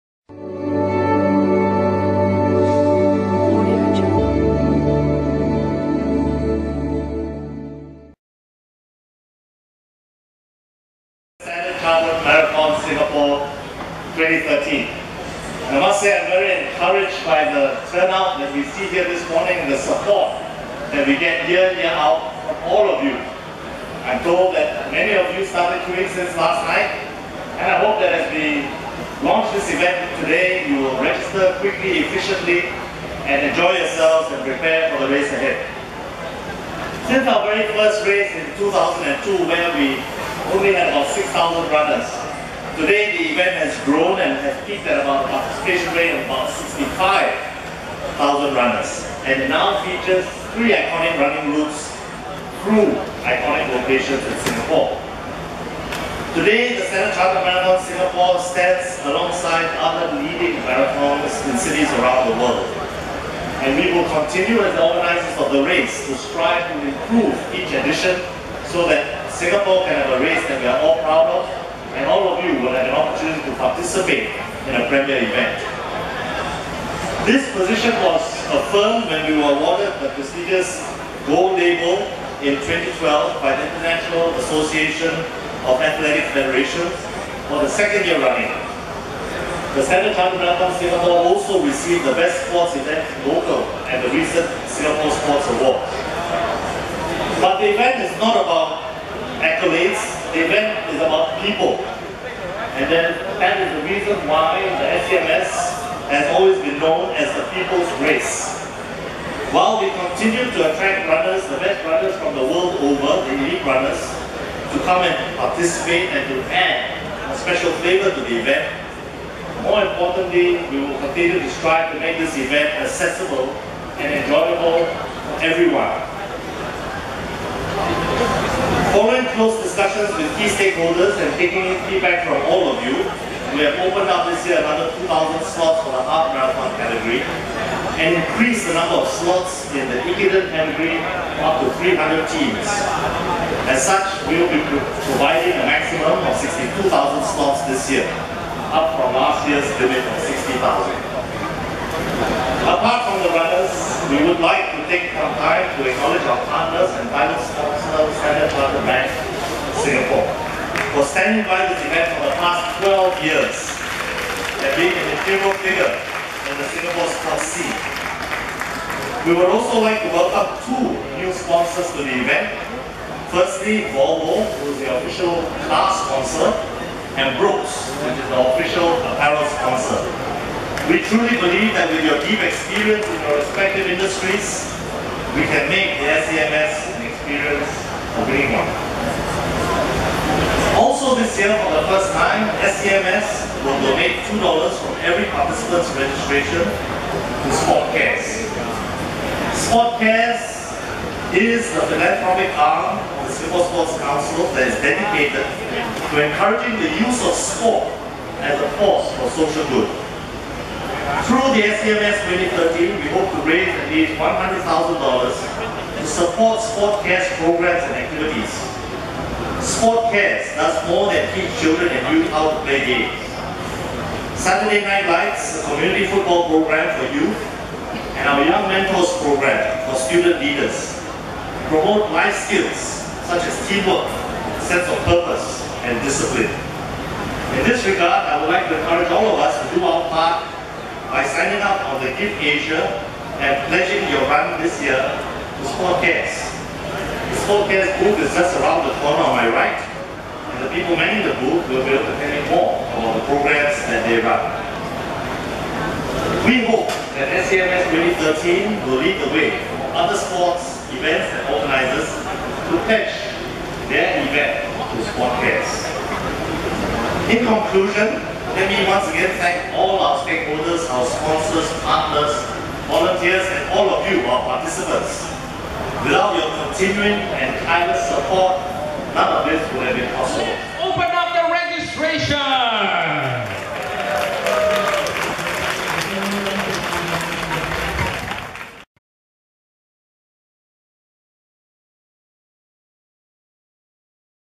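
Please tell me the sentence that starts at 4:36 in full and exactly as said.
Without your continuing and tireless support, none of this would have been possible.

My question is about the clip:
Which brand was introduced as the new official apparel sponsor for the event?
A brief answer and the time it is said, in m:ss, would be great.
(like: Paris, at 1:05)
Brooks, at 2:57.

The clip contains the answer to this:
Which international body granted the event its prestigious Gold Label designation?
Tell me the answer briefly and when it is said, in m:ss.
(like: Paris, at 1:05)
International Association of Athletic Federations, at 1:23.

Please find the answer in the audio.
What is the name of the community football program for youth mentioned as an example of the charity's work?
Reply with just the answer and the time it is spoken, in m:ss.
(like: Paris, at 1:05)
Saturday Night Lights, at 3:44.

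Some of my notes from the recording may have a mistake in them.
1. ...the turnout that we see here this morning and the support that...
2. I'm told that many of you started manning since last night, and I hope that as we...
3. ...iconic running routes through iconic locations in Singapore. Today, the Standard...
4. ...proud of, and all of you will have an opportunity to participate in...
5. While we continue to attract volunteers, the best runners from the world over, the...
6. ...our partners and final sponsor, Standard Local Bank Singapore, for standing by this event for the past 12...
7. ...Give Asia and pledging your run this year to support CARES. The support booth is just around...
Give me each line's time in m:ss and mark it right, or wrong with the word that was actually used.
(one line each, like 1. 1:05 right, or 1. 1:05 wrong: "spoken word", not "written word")
1. 0:17 right
2. 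0:24 wrong: "queuing", not "manning"
3. 0:50 right
4. 1:11 right
5. 1:49 wrong: "runners", not "volunteers"
6. 2:36 wrong: "Chartered", not "Local"
7. 4:02 right.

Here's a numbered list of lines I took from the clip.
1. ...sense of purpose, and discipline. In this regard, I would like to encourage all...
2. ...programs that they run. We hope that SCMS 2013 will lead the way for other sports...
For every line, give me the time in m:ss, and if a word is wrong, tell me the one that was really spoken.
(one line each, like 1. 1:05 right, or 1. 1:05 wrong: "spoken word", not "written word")
1. 3:54 right
2. 4:13 right.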